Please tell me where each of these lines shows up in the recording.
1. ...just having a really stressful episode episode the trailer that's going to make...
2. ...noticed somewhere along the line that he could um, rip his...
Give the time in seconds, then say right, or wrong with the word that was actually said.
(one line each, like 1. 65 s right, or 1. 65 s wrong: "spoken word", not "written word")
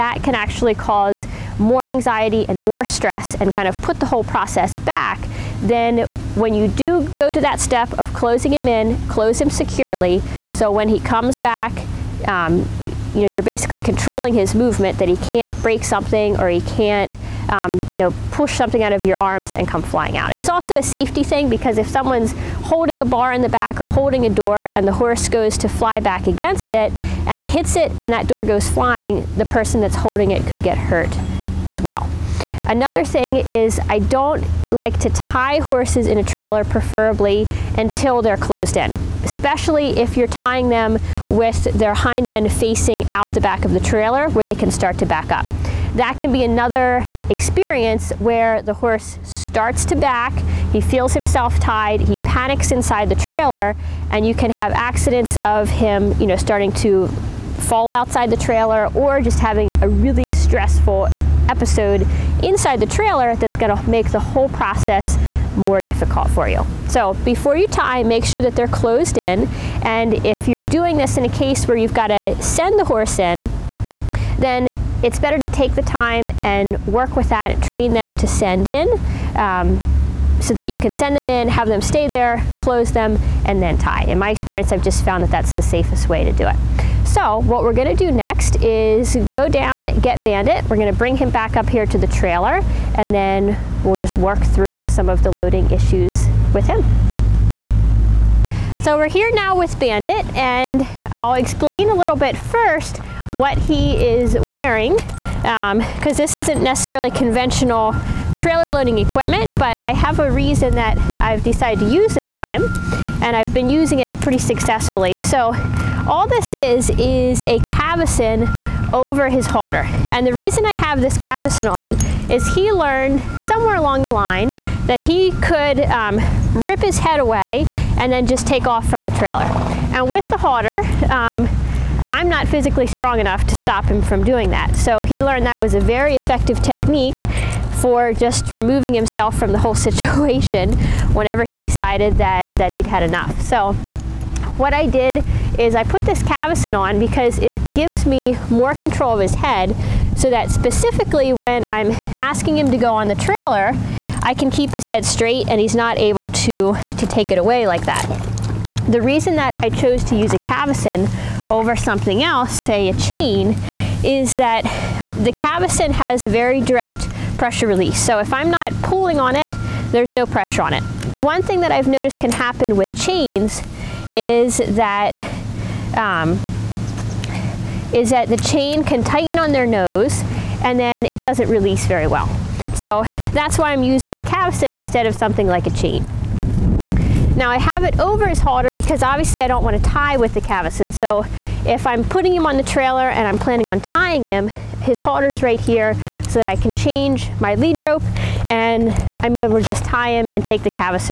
1. 59 s wrong: "inside", not "episode"
2. 122 s wrong: "learned", not "noticed".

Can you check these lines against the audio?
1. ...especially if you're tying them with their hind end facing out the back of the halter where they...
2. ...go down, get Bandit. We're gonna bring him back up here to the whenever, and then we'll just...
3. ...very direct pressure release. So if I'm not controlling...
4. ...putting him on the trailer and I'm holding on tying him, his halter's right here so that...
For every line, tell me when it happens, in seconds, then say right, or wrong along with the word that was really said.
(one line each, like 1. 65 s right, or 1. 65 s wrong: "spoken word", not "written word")
1. 39 s wrong: "trailer", not "halter"
2. 89 s wrong: "trailer", not "whenever"
3. 166 s wrong: "pulling", not "controlling"
4. 192 s wrong: "planning", not "holding".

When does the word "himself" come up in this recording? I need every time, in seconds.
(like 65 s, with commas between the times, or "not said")
51 s, 138 s.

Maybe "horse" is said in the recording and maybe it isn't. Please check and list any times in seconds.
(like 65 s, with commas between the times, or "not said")
24 s, 35 s, 48 s, 72 s.